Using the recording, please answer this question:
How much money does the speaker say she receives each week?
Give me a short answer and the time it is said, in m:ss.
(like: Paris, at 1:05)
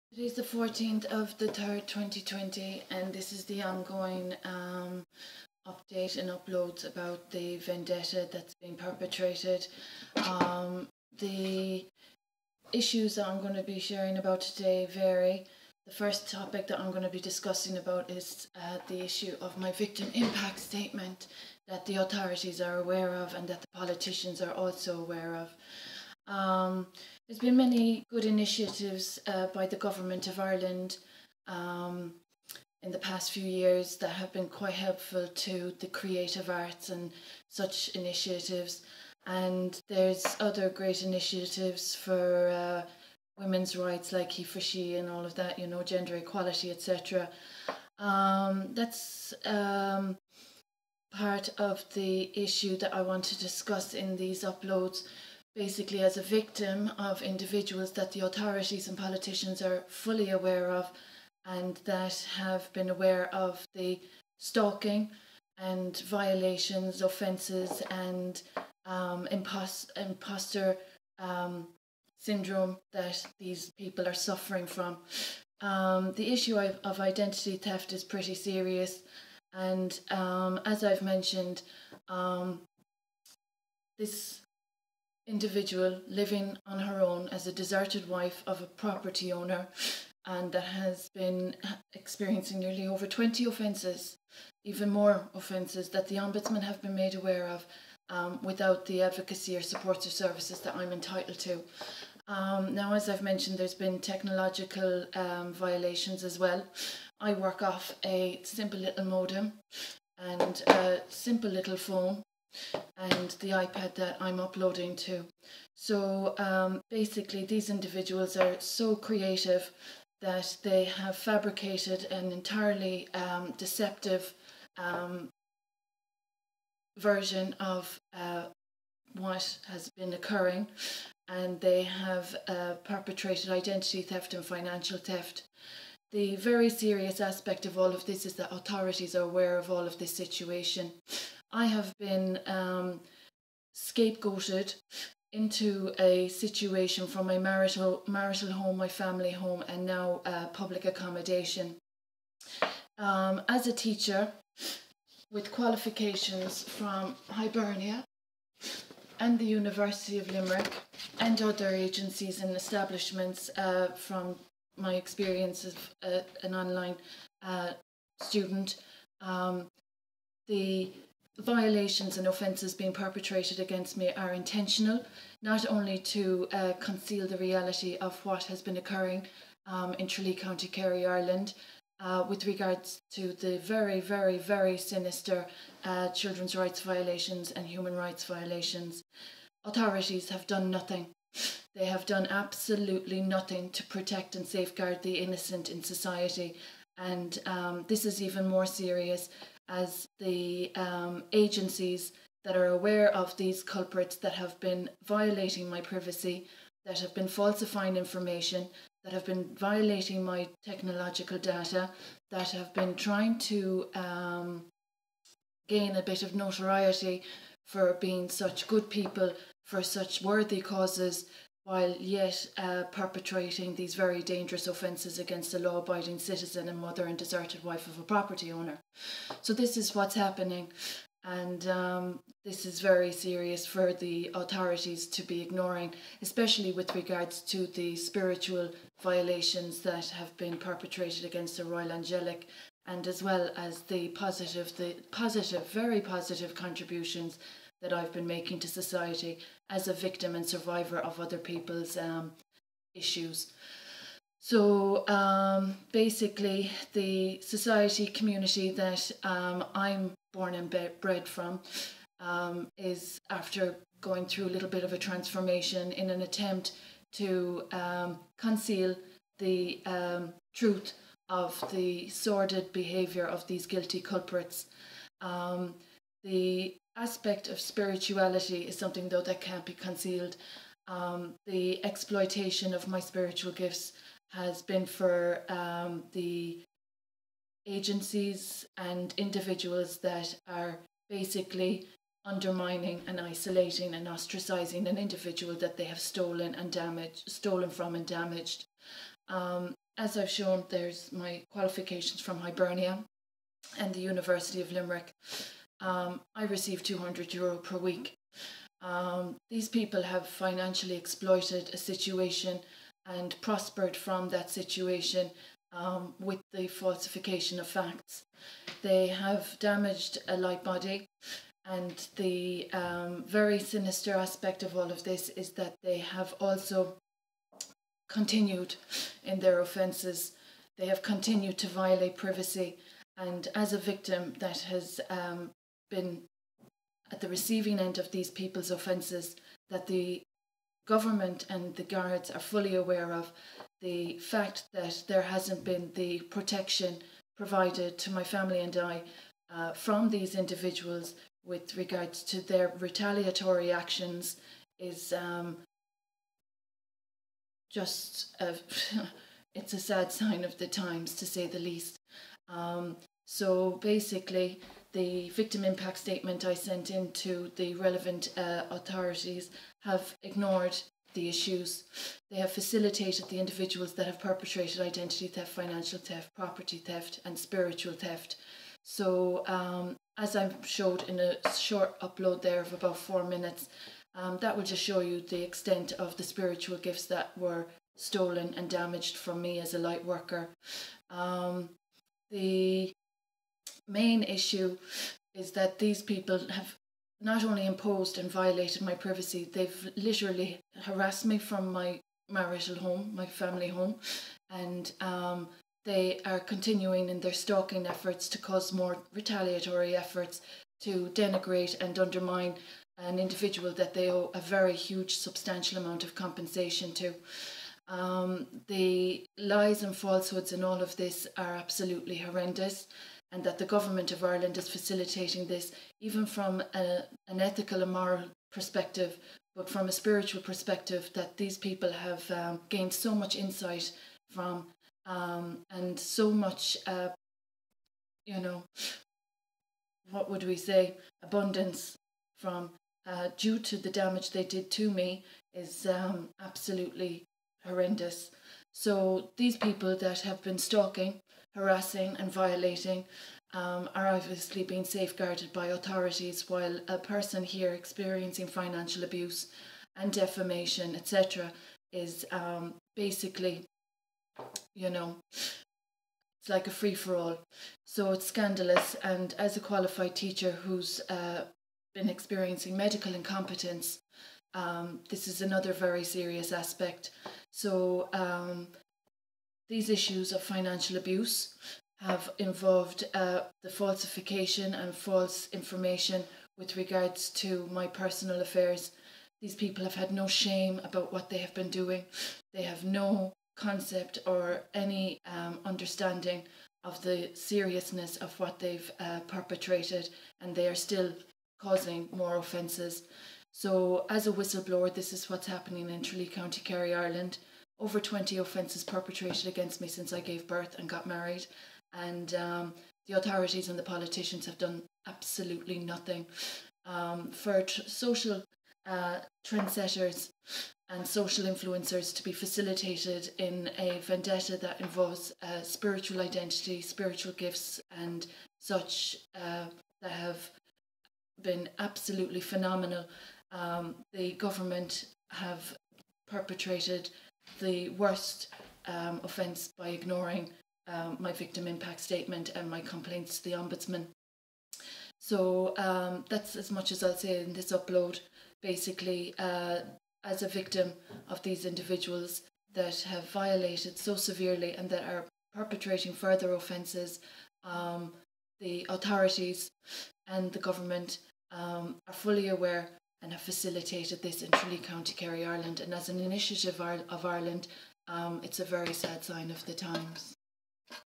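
200 euro, at 5:06.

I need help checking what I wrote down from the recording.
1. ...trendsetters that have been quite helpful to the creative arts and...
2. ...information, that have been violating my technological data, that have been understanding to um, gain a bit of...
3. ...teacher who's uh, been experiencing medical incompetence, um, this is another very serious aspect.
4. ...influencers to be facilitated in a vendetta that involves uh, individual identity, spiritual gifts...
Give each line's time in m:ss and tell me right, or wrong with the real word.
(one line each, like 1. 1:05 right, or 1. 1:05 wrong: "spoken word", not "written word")
1. 0:33 wrong: "years", not "trendsetters"
2. 3:27 wrong: "trying", not "understanding"
3. 7:50 right
4. 8:41 wrong: "spiritual", not "individual".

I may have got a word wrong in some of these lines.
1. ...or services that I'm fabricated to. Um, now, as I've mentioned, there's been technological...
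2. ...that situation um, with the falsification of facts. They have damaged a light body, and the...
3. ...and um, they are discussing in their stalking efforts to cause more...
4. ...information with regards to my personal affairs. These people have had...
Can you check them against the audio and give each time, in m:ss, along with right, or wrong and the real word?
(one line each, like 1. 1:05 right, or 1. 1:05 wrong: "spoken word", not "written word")
1. 1:39 wrong: "entitled", not "fabricated"
2. 5:14 right
3. 6:44 wrong: "continuing", not "discussing"
4. 8:05 right.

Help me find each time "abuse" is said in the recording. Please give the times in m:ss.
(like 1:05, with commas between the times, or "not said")
7:39, 8:00.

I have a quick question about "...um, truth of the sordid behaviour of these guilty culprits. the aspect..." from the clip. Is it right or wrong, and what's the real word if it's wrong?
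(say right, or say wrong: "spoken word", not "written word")
right.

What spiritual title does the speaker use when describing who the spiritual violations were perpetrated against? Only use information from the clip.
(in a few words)
Royal Angelic.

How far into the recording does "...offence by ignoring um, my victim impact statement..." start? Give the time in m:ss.
8:59.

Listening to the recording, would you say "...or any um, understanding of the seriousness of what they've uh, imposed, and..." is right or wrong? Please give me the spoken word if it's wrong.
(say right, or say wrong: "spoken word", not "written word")
wrong: "perpetrated", not "imposed".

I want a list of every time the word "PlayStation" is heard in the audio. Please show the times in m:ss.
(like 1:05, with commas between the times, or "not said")
not said.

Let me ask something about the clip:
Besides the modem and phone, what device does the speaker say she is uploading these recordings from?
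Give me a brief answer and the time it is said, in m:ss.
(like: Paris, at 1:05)
iPad, at 1:53.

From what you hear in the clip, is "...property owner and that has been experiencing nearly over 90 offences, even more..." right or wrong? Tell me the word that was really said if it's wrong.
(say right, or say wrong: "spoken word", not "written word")
wrong: "20", not "90".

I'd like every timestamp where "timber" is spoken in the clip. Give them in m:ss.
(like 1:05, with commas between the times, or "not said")
not said.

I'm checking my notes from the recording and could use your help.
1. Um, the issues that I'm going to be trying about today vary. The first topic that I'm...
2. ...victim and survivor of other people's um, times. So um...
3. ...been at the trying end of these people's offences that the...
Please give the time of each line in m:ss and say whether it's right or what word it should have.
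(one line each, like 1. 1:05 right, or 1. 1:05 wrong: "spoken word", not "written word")
1. 0:10 wrong: "sharing", not "trying"
2. 4:09 wrong: "issues", not "times"
3. 5:35 wrong: "receiving", not "trying".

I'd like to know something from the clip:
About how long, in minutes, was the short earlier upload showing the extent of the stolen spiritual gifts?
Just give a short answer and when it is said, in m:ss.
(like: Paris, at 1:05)
4, at 6:22.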